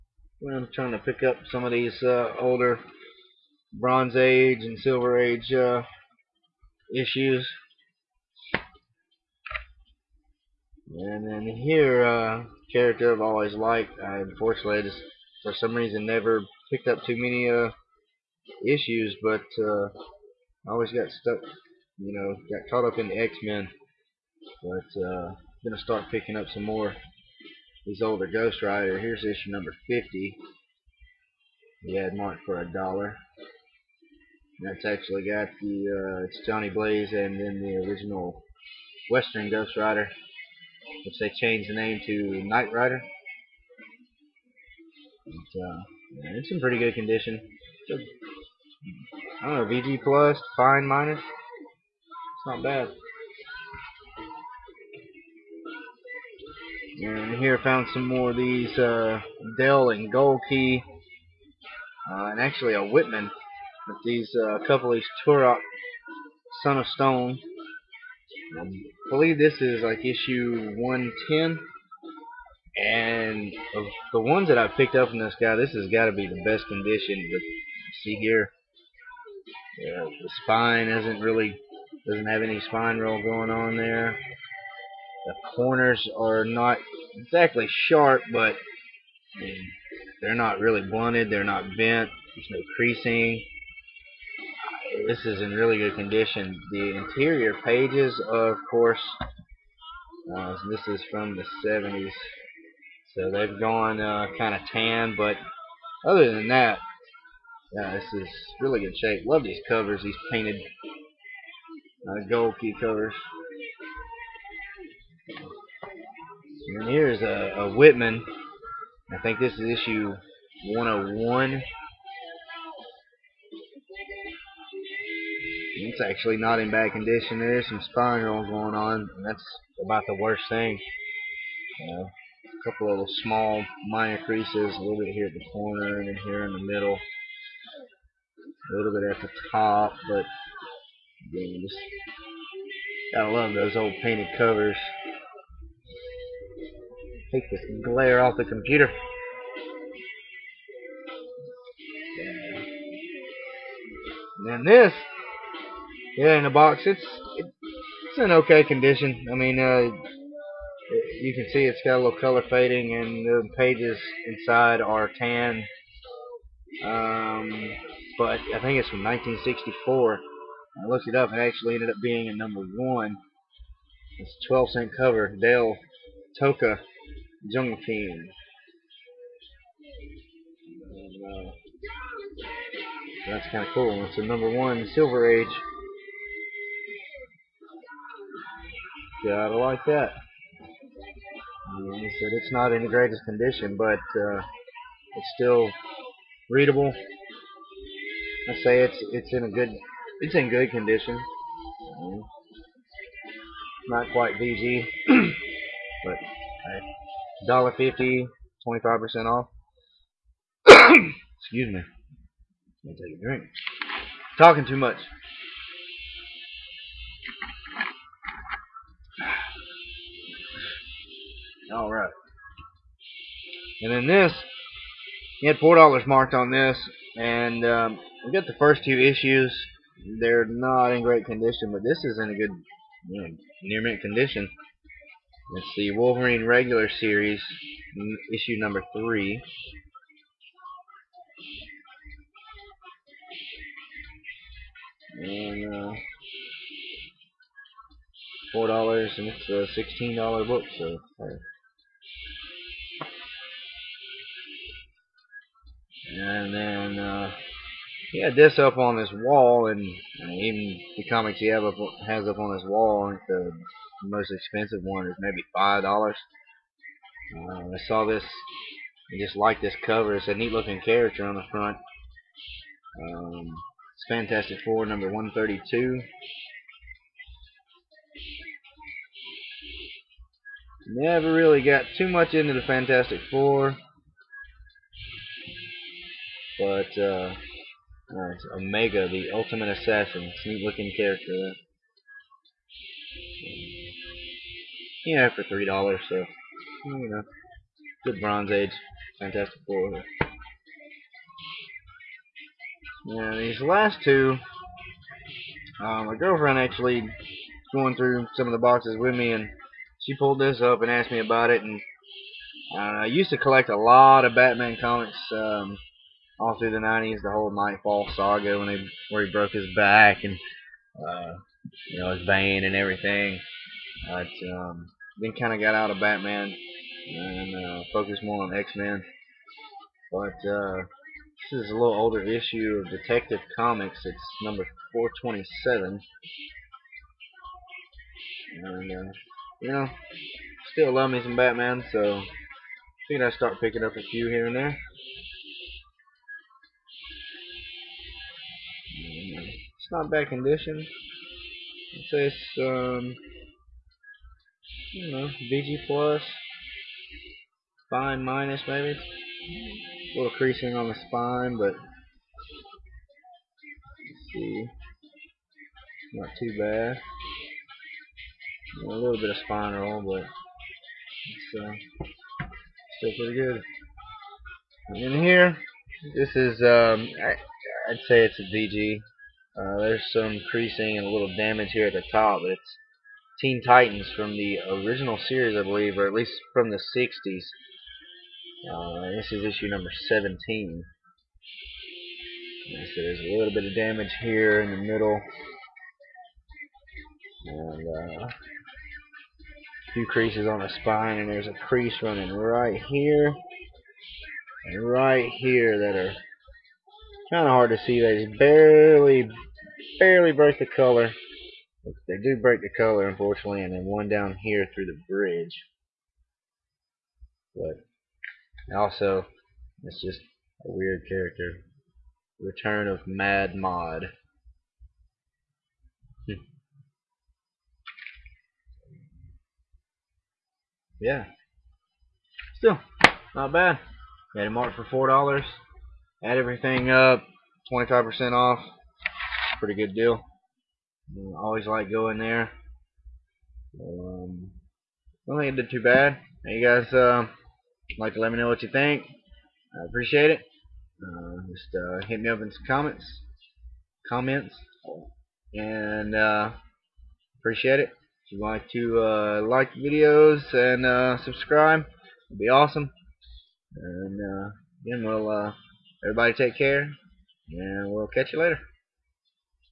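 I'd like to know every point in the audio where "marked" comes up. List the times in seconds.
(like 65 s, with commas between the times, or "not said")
32 s, 226 s, 434 s.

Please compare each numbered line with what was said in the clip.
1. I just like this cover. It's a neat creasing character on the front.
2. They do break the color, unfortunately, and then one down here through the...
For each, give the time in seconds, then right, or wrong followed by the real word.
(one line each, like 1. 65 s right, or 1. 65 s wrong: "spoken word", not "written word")
1. 268 s wrong: "looking", not "creasing"
2. 412 s right.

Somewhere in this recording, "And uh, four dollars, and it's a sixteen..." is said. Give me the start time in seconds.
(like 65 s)
245 s.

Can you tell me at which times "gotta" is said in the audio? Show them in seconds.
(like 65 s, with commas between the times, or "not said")
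143 s, 189 s.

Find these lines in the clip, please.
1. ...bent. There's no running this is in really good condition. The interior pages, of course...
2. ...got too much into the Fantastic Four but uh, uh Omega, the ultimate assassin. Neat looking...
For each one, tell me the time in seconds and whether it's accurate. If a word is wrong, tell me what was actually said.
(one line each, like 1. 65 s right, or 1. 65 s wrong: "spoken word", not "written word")
1. 91 s wrong: "creasing", not "running"
2. 281 s right.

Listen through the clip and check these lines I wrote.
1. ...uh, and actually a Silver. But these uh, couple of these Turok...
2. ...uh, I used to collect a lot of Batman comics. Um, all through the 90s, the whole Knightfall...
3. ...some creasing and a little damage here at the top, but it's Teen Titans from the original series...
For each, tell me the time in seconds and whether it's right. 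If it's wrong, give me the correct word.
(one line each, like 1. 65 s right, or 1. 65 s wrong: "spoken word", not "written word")
1. 62 s wrong: "Whitman", not "Silver"
2. 312 s right
3. 380 s right.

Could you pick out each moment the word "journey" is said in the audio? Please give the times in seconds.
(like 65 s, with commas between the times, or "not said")
not said.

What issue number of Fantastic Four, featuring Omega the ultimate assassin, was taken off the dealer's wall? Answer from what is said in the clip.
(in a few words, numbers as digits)
132.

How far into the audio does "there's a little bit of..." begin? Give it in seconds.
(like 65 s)
392 s.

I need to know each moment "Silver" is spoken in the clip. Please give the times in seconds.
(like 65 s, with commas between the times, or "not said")
4 s, 184 s.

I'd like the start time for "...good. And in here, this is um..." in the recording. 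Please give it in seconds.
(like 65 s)
373 s.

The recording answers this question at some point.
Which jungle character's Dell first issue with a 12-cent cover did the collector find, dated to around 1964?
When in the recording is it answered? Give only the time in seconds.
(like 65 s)
176 s.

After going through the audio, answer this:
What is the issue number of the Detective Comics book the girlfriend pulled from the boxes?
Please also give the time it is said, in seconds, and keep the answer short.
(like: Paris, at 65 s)
427, at 334 s.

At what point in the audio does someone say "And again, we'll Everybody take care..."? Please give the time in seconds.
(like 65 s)
463 s.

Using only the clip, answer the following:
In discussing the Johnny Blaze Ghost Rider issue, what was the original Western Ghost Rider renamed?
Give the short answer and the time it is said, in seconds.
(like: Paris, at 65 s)
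Night Rider, at 42 s.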